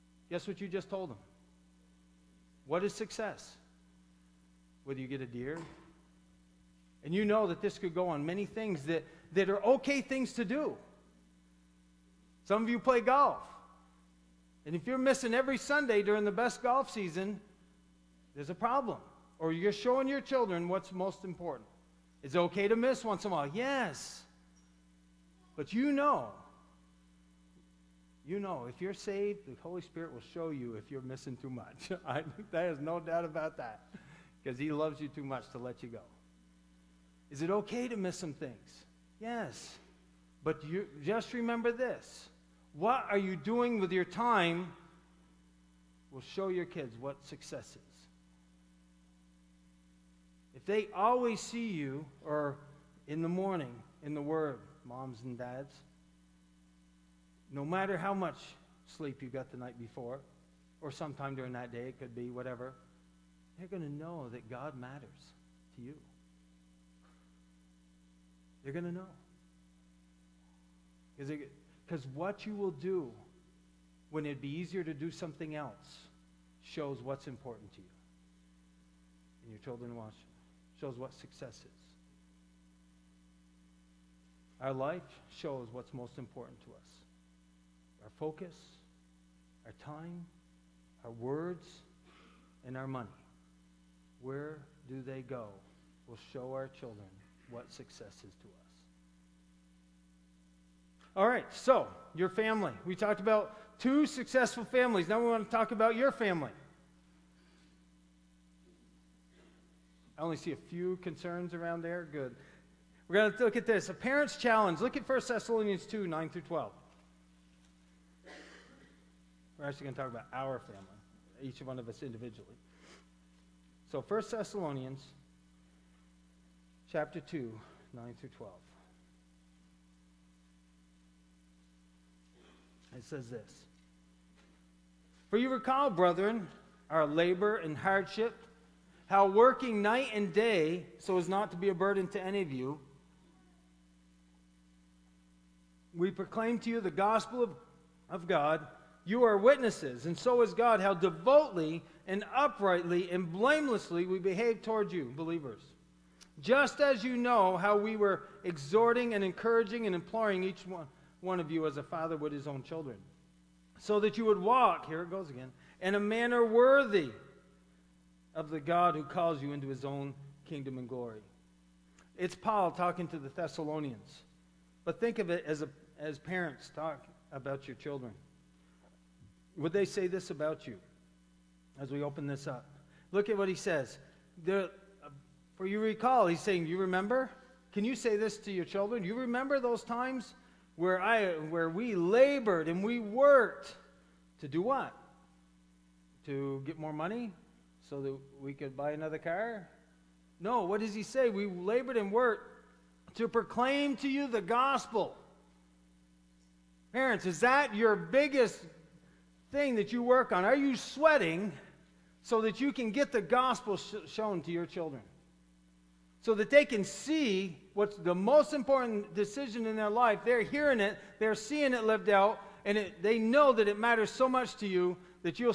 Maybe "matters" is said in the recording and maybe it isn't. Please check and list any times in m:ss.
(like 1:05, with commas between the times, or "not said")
0:57, 1:04, 3:43.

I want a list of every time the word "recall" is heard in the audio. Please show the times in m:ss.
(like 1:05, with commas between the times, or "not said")
2:15, 3:05.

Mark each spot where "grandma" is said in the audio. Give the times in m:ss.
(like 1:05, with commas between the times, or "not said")
not said.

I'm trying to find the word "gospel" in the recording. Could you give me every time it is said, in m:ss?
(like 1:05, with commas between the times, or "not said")
2:26, 3:24, 3:33.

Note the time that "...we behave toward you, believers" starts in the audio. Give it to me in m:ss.
2:34.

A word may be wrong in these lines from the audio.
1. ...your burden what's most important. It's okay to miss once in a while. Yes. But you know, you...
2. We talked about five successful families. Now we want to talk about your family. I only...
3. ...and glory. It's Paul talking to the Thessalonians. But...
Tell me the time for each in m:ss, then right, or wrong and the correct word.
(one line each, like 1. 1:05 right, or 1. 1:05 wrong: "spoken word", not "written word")
1. 0:20 wrong: "children", not "burden"
2. 1:42 wrong: "two", not "five"
3. 2:50 right.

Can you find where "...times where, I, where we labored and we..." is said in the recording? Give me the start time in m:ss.
3:09.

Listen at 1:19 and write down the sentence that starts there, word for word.
And your children watch Shows what success is.